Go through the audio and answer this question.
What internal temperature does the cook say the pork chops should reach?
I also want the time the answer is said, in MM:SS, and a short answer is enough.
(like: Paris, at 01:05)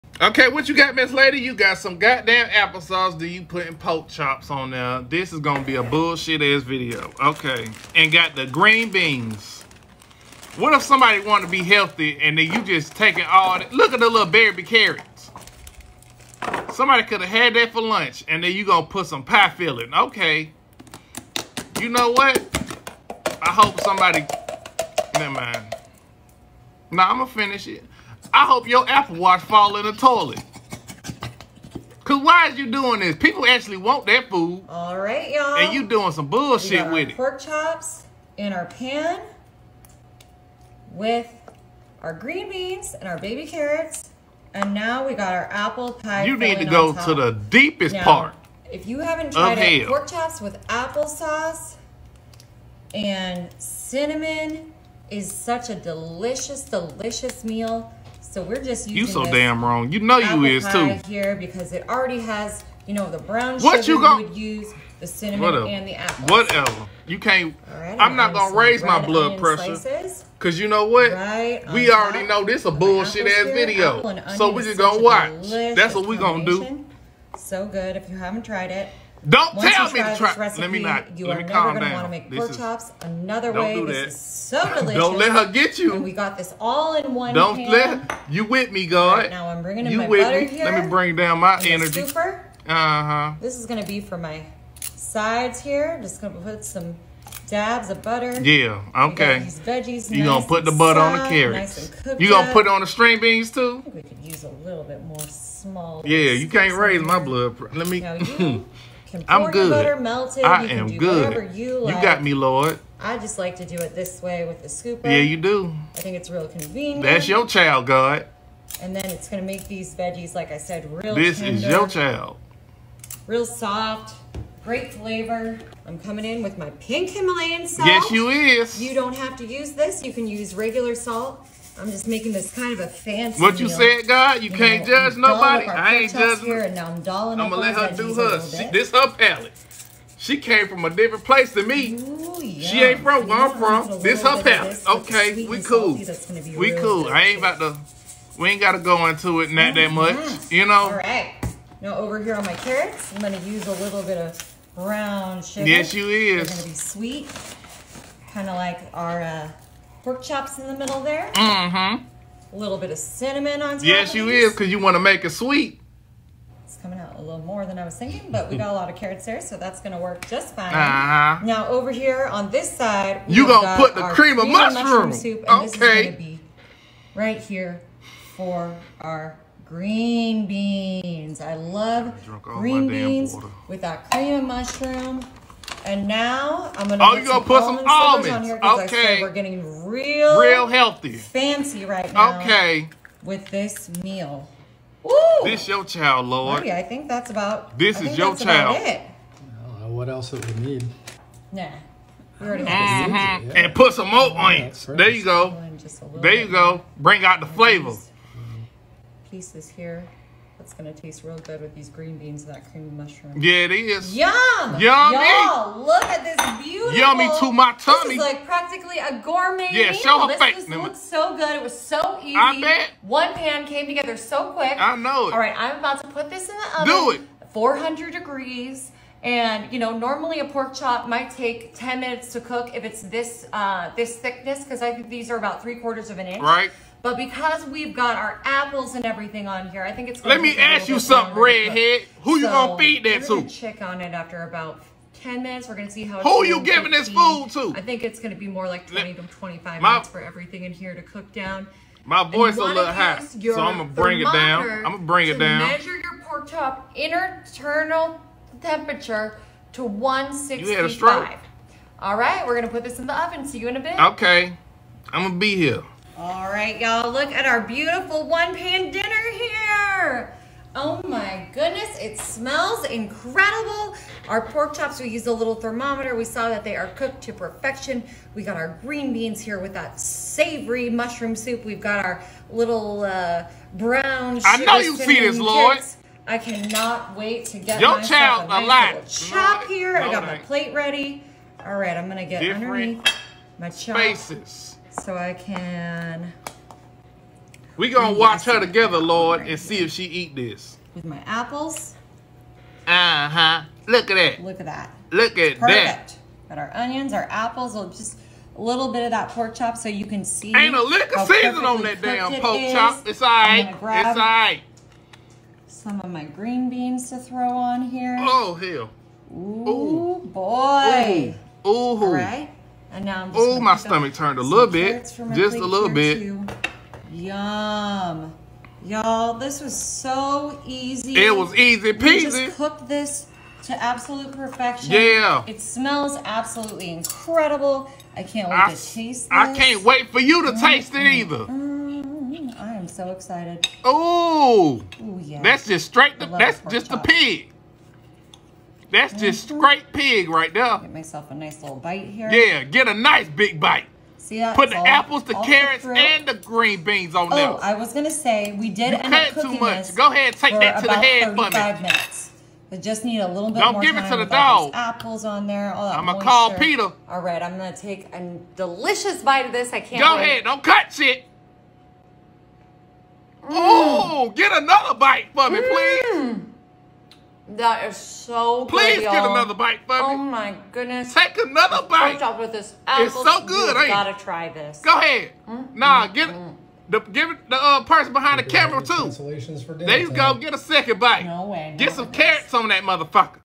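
165, at 04:19.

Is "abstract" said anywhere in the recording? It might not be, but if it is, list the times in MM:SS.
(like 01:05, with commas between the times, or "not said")
not said.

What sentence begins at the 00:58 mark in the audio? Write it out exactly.
So we're just using You so damn wrong.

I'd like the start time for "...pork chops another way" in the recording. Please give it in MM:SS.
01:22.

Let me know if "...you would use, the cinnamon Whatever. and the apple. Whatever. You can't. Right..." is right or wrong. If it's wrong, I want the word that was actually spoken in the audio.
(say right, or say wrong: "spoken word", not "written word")
right.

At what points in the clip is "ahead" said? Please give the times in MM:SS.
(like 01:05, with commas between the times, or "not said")
06:00, 06:10, 06:24.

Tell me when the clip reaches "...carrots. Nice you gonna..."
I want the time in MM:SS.
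01:41.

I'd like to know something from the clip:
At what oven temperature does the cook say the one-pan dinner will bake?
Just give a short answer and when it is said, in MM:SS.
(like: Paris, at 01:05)
400 degrees, at 03:47.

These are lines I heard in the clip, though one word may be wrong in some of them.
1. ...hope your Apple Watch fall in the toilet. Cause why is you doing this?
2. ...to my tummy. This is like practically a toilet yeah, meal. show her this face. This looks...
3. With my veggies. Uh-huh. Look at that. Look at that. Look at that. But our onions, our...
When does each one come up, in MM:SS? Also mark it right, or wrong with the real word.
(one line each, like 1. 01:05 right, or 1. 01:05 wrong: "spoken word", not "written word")
1. 00:28 right
2. 03:37 wrong: "gourmet", not "toilet"
3. 05:00 wrong: "apples", not "veggies".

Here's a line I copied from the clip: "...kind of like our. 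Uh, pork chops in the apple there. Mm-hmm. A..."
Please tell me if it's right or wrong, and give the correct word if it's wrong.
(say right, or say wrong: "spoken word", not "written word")
wrong: "middle", not "apple".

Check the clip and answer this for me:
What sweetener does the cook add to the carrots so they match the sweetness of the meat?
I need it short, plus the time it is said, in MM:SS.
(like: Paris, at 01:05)
brown sugar, at 02:34.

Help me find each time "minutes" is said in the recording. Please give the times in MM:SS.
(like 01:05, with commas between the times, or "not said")
03:51, 04:05, 04:09, 06:01.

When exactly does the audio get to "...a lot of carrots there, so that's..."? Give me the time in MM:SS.
02:48.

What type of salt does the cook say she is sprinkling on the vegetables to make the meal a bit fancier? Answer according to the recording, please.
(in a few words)
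pink Himalayan salt.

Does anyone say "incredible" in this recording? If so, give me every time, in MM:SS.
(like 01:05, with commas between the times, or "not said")
04:32, 05:36.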